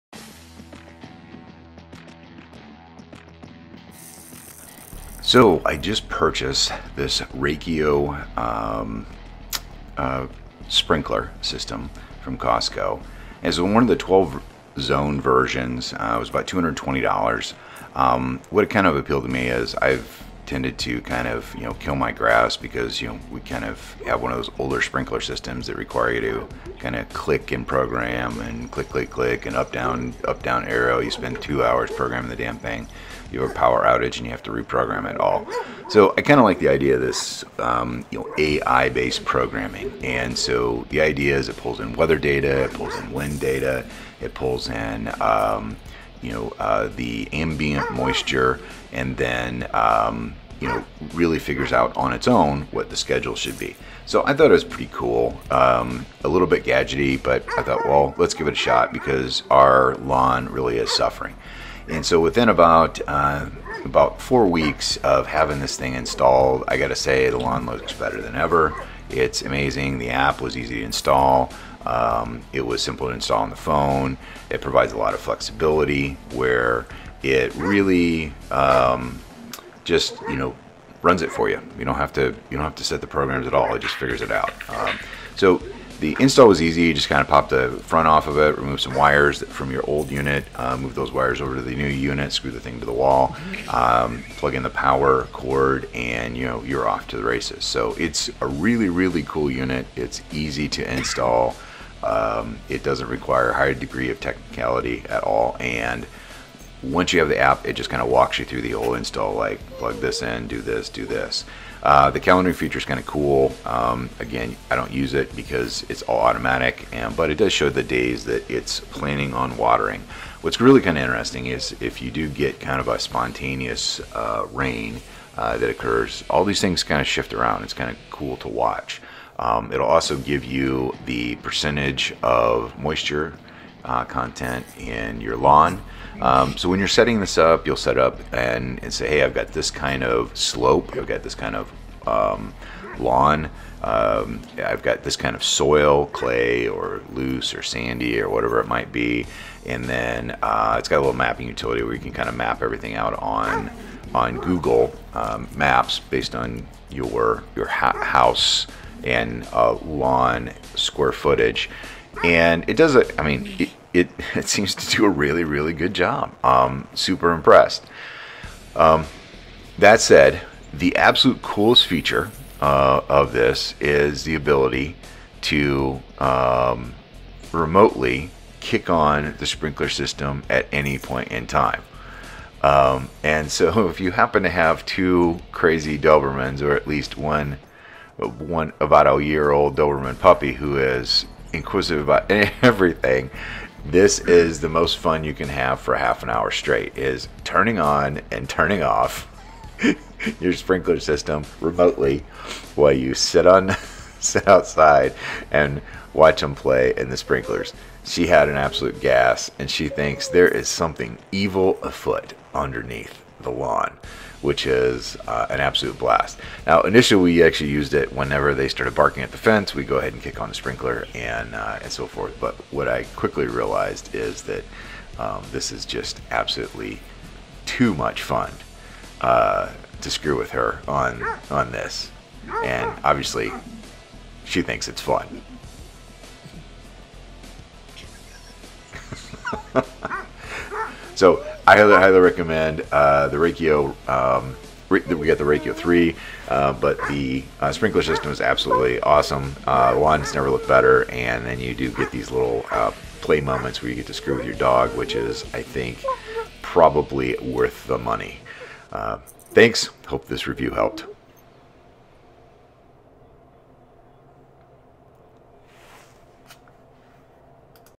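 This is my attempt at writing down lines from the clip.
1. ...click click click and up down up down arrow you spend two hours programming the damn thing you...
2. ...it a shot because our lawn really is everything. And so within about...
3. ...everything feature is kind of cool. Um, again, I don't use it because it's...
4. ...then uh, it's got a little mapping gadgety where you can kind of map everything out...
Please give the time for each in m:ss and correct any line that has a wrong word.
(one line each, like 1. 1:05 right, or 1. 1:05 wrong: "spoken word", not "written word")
1. 0:28 right
2. 0:58 wrong: "suffering", not "everything"
3. 1:52 wrong: "calendaring", not "everything"
4. 2:29 wrong: "utility", not "gadgety".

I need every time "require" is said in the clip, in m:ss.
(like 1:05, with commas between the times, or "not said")
0:25, 1:43.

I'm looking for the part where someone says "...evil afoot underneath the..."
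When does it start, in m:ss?
3:31.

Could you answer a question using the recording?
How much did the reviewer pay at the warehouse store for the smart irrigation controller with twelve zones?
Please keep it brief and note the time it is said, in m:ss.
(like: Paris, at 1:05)
$220, at 0:16.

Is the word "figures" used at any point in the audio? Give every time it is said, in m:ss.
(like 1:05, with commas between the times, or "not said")
0:51, 1:23.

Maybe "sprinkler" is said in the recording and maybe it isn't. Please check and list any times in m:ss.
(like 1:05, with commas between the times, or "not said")
0:10, 0:24, 2:59, 3:20, 3:27, 3:40, 4:07.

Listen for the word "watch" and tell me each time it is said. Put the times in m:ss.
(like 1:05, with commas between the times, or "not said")
2:08, 3:26.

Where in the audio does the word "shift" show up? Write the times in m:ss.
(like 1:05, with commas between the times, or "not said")
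2:07.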